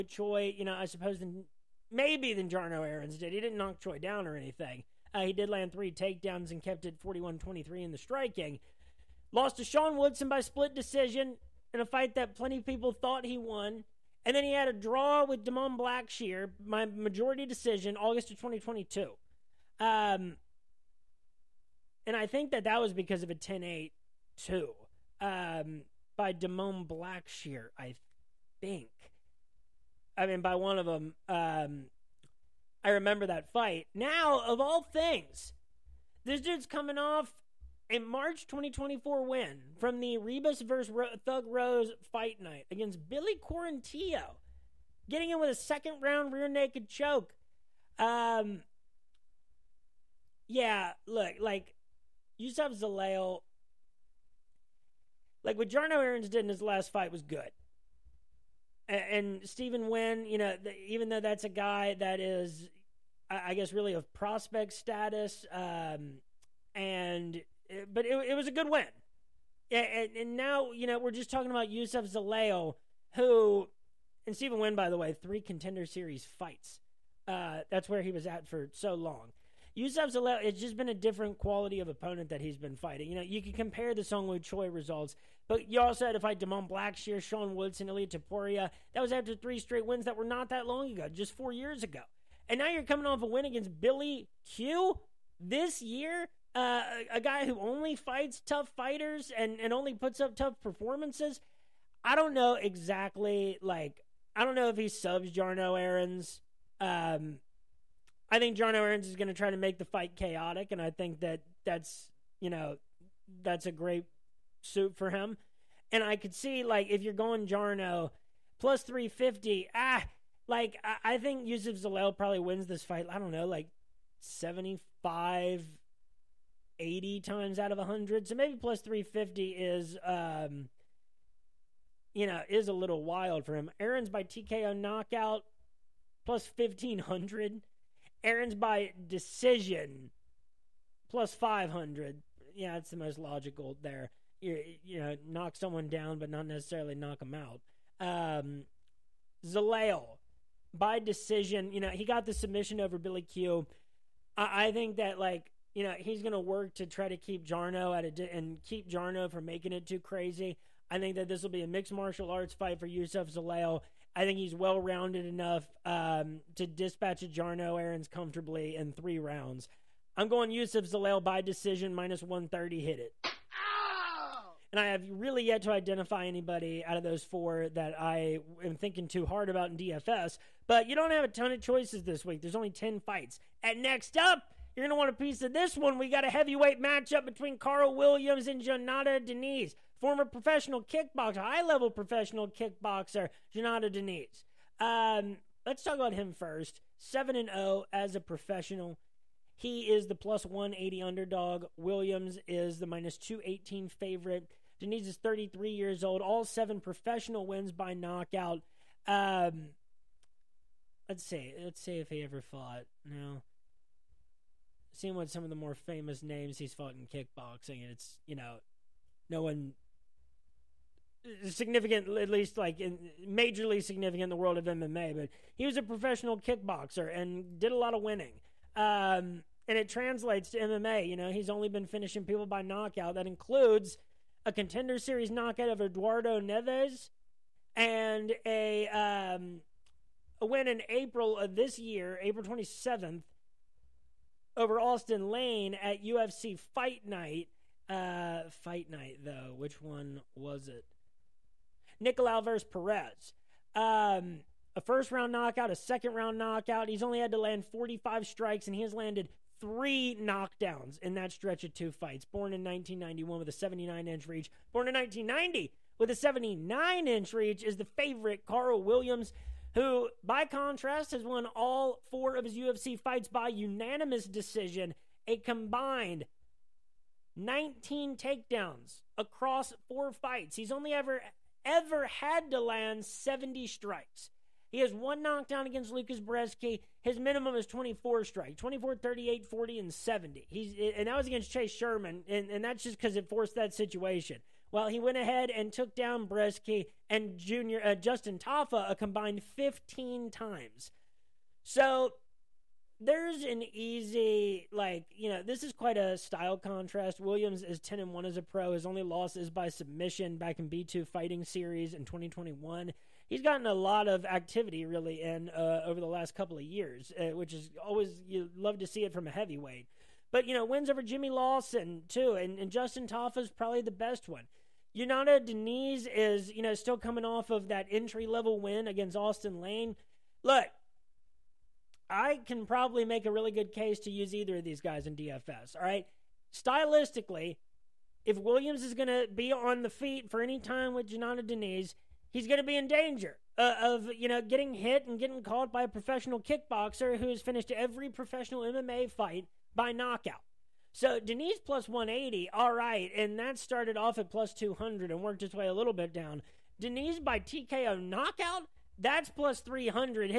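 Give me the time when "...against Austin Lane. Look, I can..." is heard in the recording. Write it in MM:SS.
05:28.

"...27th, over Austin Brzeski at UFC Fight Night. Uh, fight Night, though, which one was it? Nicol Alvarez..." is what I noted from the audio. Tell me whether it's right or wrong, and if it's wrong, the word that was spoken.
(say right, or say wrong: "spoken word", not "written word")
wrong: "Lane", not "Brzeski".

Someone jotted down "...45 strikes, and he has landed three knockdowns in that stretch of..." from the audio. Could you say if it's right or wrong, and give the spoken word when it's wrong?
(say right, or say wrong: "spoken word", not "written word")
right.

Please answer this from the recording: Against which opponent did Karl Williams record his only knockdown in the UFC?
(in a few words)
Lucas Brzeski.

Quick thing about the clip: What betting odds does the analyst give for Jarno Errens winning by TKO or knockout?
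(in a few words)
+1500.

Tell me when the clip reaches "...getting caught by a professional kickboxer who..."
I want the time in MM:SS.
05:45.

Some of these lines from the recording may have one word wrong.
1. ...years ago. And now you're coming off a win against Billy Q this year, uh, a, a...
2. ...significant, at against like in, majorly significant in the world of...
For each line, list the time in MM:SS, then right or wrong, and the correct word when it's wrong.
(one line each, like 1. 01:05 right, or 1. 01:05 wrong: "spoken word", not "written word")
1. 01:31 right
2. 03:41 wrong: "least", not "against".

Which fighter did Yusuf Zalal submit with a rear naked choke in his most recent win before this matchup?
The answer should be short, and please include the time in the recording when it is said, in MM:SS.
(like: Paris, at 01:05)
Billy Quarantillo, at 00:43.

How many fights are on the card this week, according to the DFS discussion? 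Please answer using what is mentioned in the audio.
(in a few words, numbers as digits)
10.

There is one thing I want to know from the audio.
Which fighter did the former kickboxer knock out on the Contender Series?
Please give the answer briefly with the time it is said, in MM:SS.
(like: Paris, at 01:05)
Eduardo Neves, at 03:55.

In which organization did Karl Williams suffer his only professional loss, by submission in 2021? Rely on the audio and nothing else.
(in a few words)
B2 Fighting Series.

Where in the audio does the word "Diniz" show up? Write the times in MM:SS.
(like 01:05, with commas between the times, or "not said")
03:09, 03:13, 03:24, 05:25, 05:41, 05:51, 05:56.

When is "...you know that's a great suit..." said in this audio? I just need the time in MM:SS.
01:52.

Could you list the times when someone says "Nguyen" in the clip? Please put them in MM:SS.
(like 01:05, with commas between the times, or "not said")
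00:59, 01:14.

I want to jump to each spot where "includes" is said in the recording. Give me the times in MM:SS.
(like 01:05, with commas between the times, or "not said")
03:53.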